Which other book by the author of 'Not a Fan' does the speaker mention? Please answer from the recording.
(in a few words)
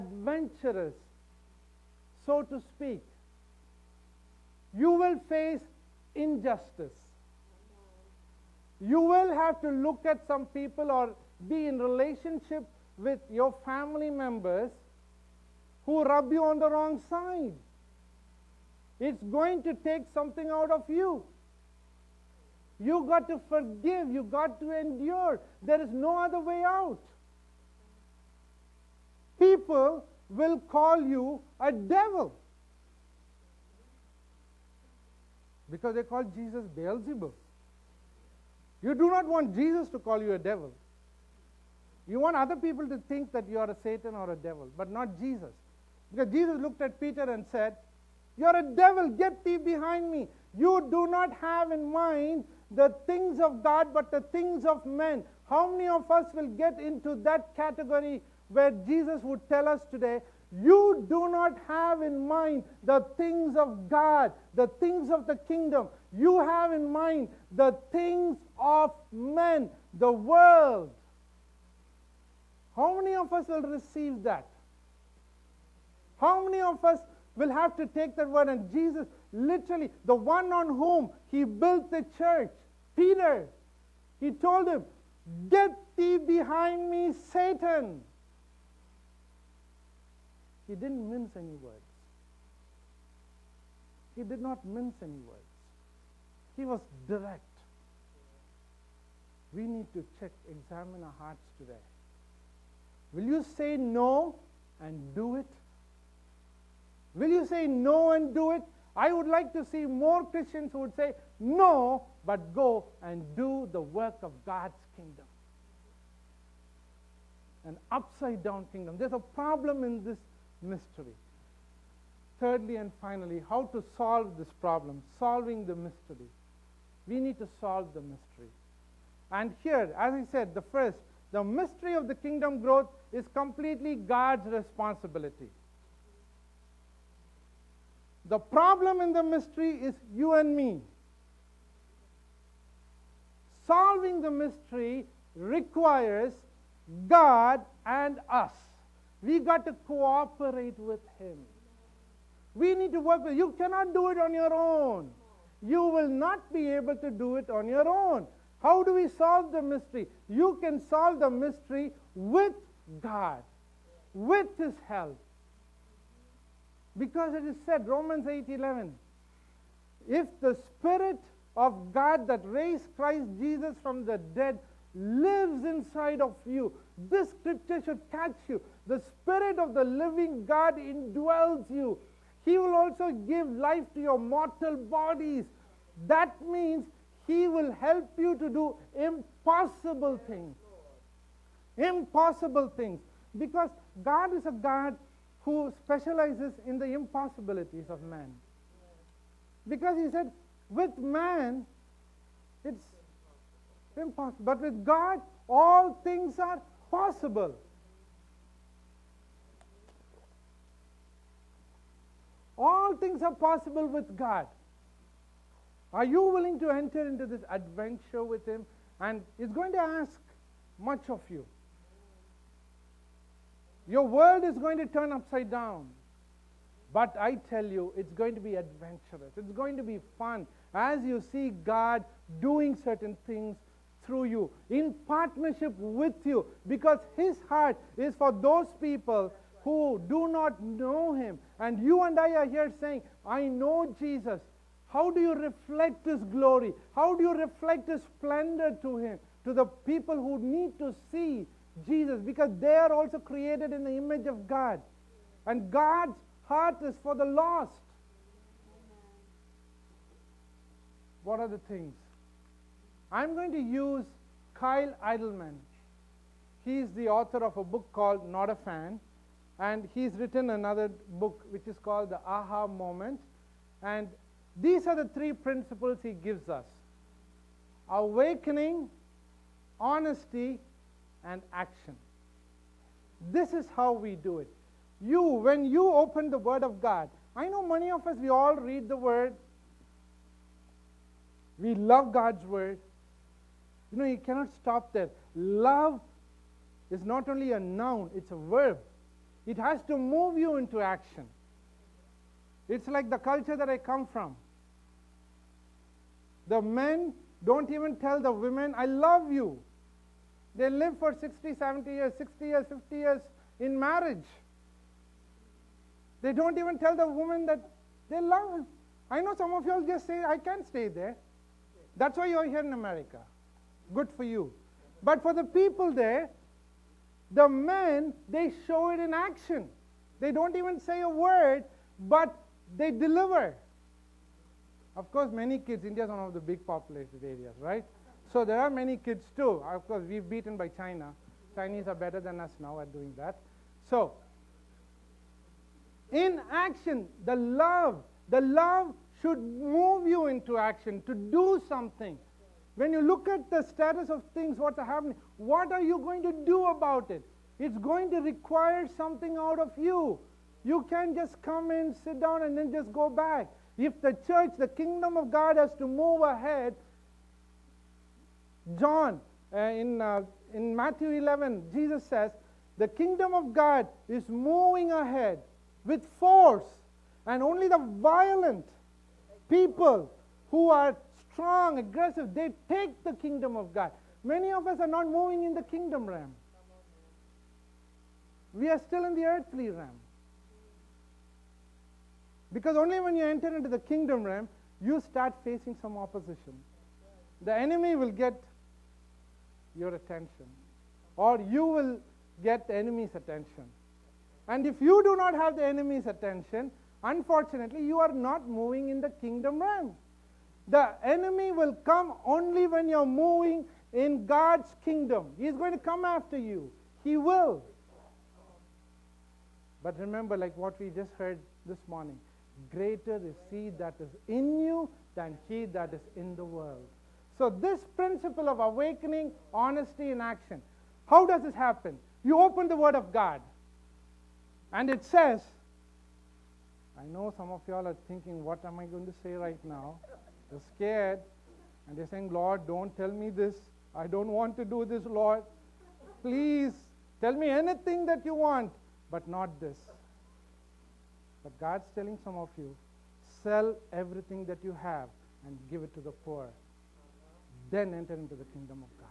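The Aha Moment.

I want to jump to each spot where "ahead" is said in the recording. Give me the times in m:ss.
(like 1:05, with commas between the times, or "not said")
6:06, 6:14.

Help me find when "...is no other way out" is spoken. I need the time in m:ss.
0:25.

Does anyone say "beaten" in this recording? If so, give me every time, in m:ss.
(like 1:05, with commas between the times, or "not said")
5:40.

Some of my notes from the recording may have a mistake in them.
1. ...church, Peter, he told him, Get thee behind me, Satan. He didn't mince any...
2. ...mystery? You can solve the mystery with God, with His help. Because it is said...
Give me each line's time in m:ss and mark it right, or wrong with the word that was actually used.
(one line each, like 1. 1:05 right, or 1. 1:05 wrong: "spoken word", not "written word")
1. 1:22 right
2. 2:39 right.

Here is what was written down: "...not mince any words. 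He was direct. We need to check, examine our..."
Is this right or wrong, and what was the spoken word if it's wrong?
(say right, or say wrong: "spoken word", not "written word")
right.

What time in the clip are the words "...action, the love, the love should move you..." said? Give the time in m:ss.
5:46.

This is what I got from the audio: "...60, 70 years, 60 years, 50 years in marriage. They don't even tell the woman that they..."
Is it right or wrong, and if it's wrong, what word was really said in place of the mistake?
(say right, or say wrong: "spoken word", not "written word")
right.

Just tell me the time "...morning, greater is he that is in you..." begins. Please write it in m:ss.
7:01.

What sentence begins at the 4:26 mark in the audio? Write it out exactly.
He's the author of a book called Not a Fan.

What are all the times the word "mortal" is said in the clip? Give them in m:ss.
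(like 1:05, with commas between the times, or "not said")
3:04.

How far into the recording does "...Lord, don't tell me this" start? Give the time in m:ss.
7:22.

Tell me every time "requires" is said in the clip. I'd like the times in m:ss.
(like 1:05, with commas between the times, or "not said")
2:25, 5:58.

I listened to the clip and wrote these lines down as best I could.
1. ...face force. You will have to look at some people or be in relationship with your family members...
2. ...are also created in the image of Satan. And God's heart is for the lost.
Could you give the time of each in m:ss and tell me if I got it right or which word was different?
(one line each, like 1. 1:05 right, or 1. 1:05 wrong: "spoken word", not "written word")
1. 0:05 wrong: "injustice", not "force"
2. 4:12 wrong: "God", not "Satan".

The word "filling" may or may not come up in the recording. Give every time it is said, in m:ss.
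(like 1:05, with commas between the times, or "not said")
not said.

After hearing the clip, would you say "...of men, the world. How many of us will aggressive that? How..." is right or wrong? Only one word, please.
wrong.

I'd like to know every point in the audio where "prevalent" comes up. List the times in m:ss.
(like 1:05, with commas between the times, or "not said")
not said.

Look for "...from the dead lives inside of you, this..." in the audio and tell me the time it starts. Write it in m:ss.
2:53.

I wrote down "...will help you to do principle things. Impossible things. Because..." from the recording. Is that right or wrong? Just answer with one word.
wrong.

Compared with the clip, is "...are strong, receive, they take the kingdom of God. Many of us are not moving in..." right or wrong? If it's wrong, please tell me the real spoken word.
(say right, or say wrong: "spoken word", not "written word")
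wrong: "aggressive", not "receive".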